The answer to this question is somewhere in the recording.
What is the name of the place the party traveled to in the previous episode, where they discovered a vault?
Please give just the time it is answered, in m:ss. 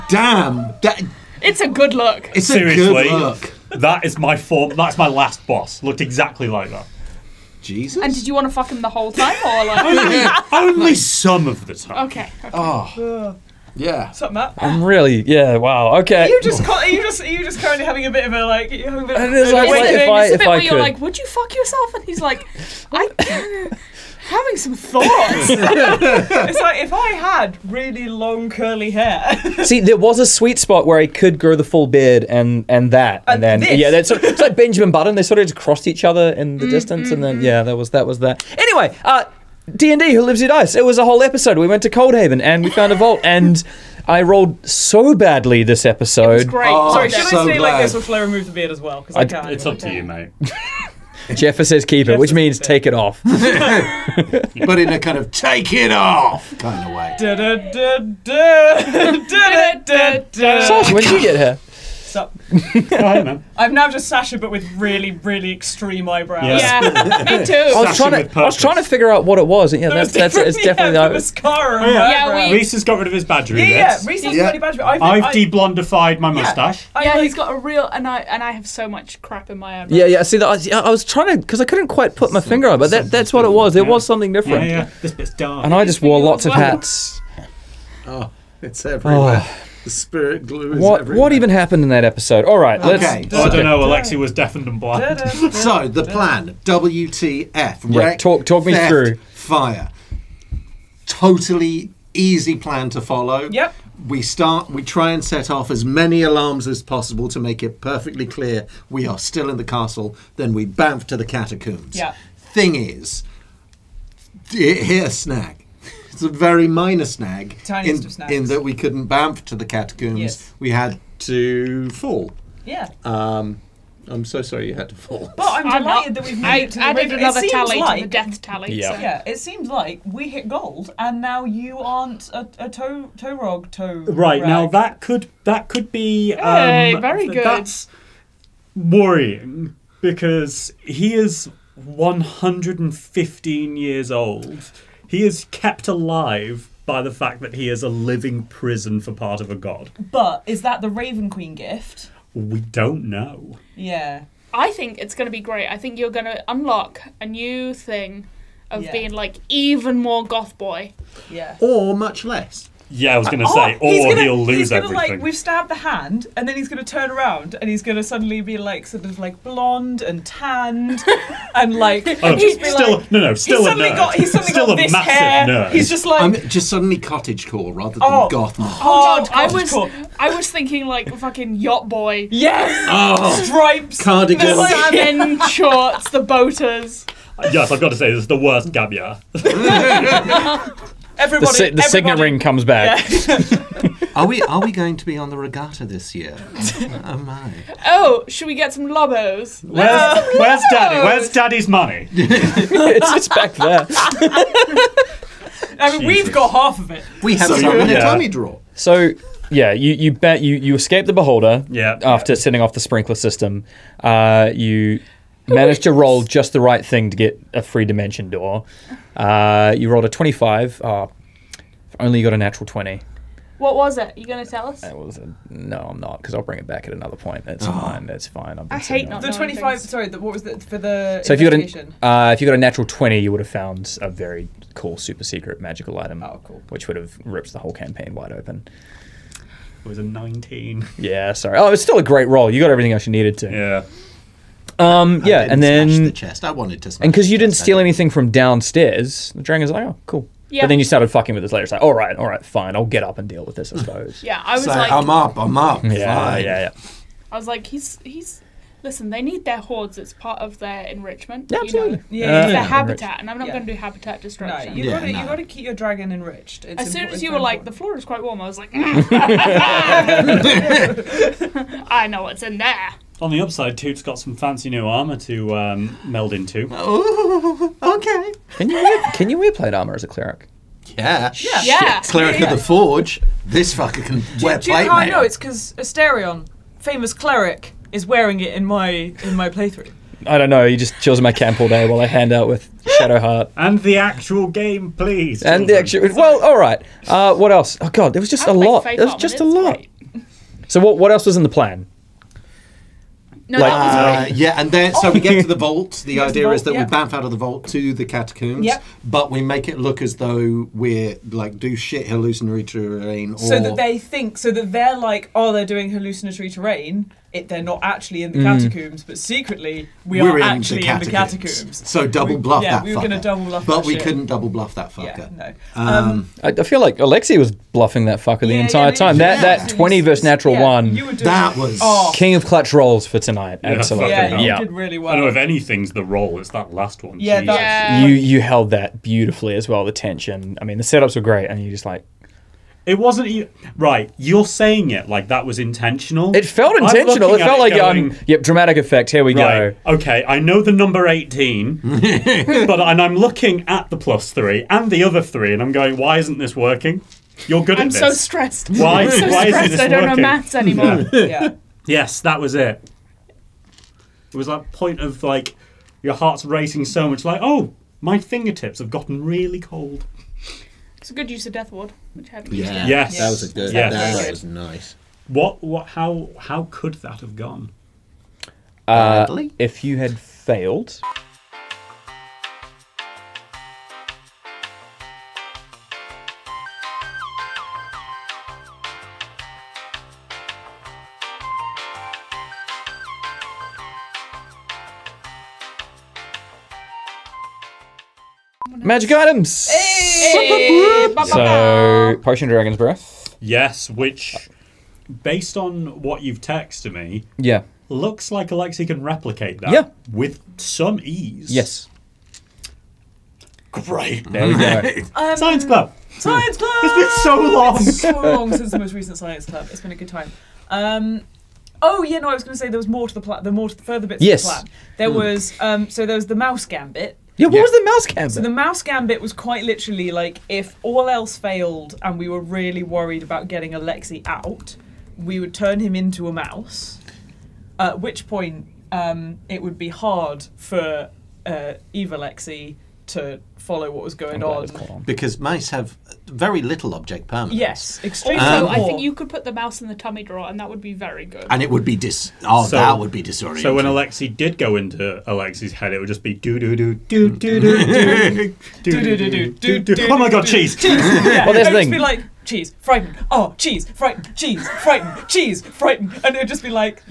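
0:41.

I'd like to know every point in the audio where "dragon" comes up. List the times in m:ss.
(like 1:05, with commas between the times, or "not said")
4:09, 4:25, 6:42.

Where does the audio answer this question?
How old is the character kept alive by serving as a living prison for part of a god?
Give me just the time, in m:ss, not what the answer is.
2:21.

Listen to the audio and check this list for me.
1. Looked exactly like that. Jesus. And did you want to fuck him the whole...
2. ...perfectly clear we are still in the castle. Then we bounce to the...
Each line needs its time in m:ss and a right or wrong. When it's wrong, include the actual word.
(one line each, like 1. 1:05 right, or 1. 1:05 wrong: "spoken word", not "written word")
1. 0:05 right
2. 1:47 right.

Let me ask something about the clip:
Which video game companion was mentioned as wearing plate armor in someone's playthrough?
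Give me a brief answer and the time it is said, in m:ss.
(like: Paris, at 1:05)
Astarion, at 4:45.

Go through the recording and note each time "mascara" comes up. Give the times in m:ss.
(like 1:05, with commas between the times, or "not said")
1:11.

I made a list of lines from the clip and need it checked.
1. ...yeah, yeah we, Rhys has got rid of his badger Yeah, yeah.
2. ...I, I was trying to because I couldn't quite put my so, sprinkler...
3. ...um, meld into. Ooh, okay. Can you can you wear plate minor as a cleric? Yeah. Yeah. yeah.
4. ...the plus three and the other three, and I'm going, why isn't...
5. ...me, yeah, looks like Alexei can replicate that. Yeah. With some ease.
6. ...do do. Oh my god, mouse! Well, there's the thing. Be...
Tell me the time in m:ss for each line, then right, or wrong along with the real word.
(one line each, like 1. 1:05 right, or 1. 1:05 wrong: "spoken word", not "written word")
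1. 1:11 right
2. 1:20 wrong: "finger", not "sprinkler"
3. 4:35 wrong: "armor", not "minor"
4. 5:53 right
5. 6:46 right
6. 7:39 wrong: "cheese", not "mouse".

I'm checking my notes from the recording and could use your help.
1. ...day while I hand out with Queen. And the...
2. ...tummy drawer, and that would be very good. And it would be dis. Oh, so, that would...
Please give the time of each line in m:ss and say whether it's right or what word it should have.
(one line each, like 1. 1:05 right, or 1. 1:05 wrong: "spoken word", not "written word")
1. 4:51 wrong: "Shadowheart", not "Queen"
2. 7:29 right.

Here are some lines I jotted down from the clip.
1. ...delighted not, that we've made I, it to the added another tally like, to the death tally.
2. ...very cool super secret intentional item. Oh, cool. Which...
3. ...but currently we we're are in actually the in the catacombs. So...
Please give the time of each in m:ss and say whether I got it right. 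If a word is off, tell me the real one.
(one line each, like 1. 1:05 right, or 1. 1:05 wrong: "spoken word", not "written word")
1. 2:05 right
2. 3:54 wrong: "magical", not "intentional"
3. 5:19 wrong: "secretly", not "currently".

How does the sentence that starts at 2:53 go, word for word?
got he's suddenly still got this hair.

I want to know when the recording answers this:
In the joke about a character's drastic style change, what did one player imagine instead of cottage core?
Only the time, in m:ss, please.
3:01.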